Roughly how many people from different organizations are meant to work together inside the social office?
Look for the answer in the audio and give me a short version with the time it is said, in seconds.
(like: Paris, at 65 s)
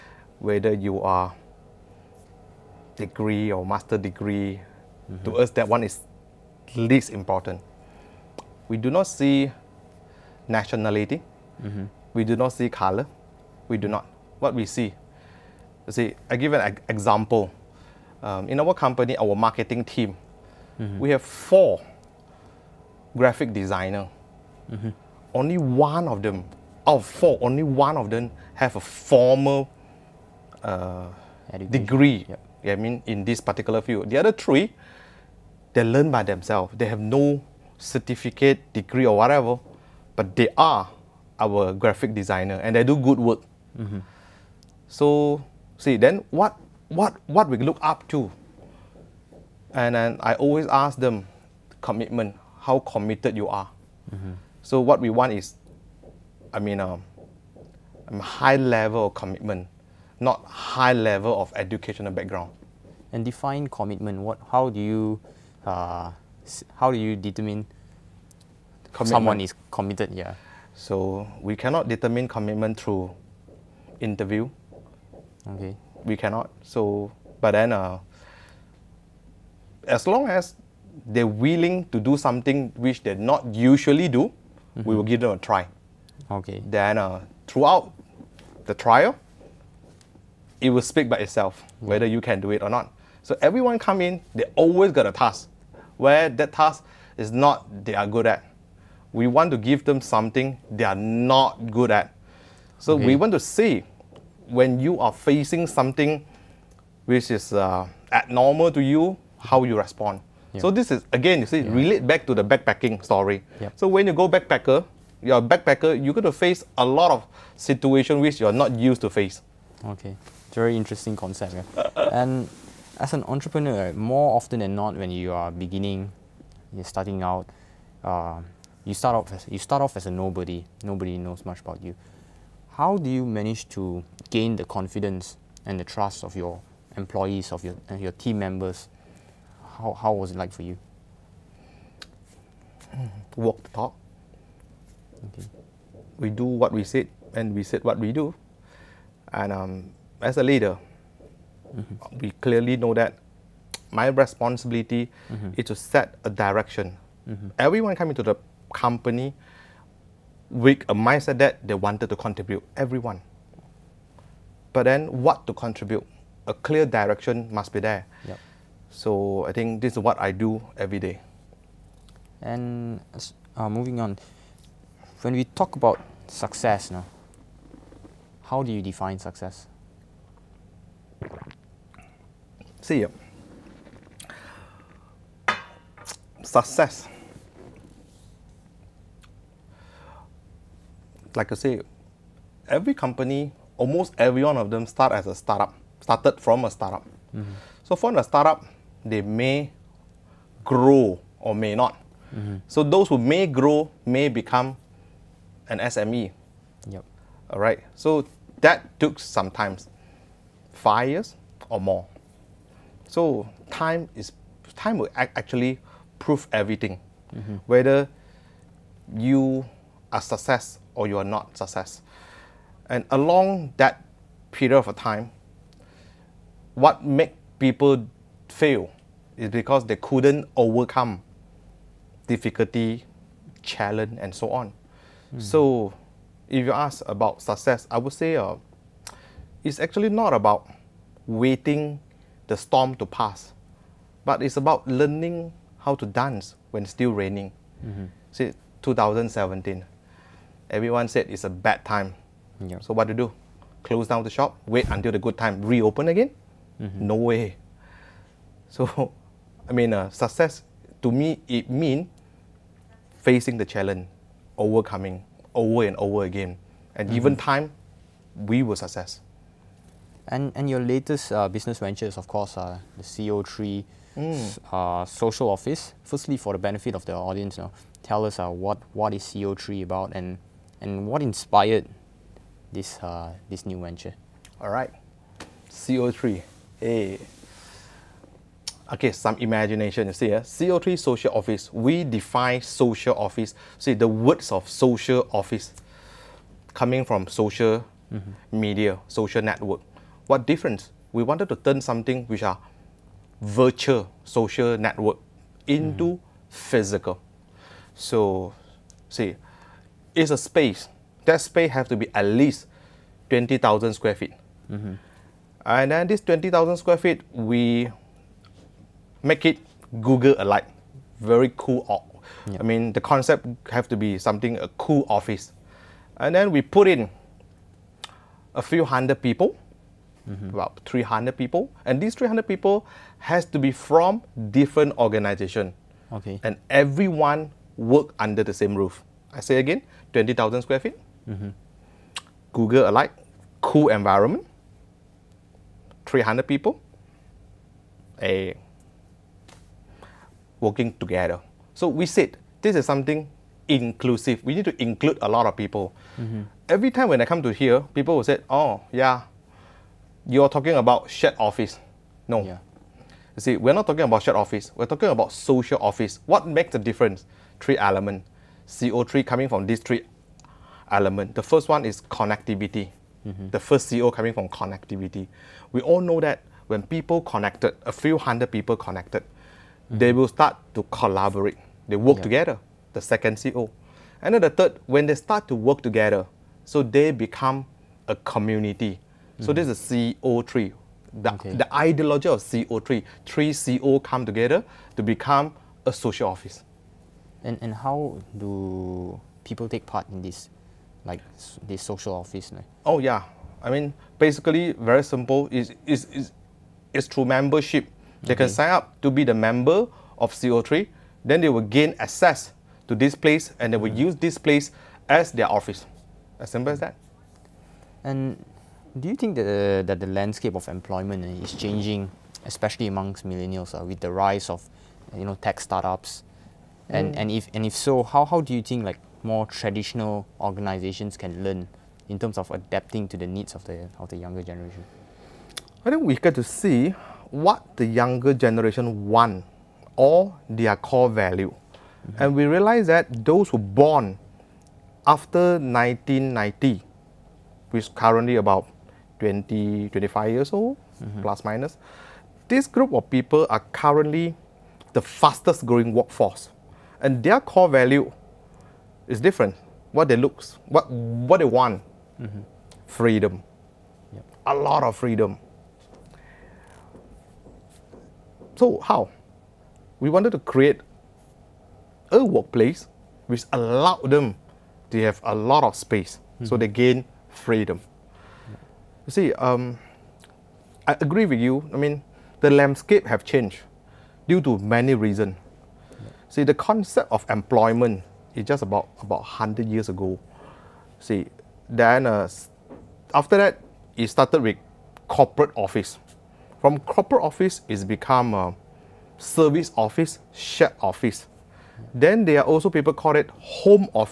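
300, at 330 s.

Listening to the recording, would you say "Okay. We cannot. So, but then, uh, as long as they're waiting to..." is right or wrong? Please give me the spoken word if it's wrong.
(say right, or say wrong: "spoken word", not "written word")
wrong: "willing", not "waiting".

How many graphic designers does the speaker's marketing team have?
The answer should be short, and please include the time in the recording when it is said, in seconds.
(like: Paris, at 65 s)
4, at 21 s.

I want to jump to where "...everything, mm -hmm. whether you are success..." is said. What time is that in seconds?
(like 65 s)
216 s.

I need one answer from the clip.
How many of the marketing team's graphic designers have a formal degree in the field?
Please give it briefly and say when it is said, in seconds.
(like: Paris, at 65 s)
1, at 27 s.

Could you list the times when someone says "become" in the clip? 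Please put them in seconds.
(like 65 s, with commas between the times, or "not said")
204 s, 387 s, 395 s, 497 s.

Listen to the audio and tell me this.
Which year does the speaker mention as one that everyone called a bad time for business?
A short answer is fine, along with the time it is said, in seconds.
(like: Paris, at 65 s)
2017, at 248 s.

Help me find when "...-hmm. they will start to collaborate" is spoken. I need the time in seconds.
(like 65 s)
379 s.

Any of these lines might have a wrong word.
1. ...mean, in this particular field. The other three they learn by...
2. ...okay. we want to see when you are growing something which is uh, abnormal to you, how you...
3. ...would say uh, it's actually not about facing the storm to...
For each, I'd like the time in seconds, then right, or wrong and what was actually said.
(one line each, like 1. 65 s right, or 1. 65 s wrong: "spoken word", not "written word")
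1. 32 s right
2. 102 s wrong: "facing", not "growing"
3. 237 s wrong: "waiting", not "facing".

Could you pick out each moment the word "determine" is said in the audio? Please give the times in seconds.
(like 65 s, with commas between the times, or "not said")
67 s, 71 s.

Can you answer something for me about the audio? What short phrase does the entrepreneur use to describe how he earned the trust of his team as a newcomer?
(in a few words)
Walk the talk.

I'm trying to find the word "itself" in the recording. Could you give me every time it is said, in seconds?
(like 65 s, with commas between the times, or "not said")
91 s.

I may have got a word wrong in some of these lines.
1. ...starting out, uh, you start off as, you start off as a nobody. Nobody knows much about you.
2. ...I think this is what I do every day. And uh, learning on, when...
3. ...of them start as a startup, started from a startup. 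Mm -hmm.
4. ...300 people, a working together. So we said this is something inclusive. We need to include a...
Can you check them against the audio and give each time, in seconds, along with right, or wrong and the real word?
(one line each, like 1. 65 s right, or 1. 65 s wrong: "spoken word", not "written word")
1. 126 s right
2. 169 s wrong: "moving", not "learning"
3. 194 s right
4. 346 s right.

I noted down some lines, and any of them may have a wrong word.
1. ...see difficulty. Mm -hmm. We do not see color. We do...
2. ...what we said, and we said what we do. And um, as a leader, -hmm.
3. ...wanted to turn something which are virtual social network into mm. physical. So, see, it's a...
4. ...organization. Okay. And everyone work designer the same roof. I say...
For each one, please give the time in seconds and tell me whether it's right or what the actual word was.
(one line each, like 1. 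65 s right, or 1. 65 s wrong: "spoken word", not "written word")
1. 9 s wrong: "nationality", not "difficulty"
2. 146 s right
3. 301 s right
4. 334 s wrong: "under", not "designer".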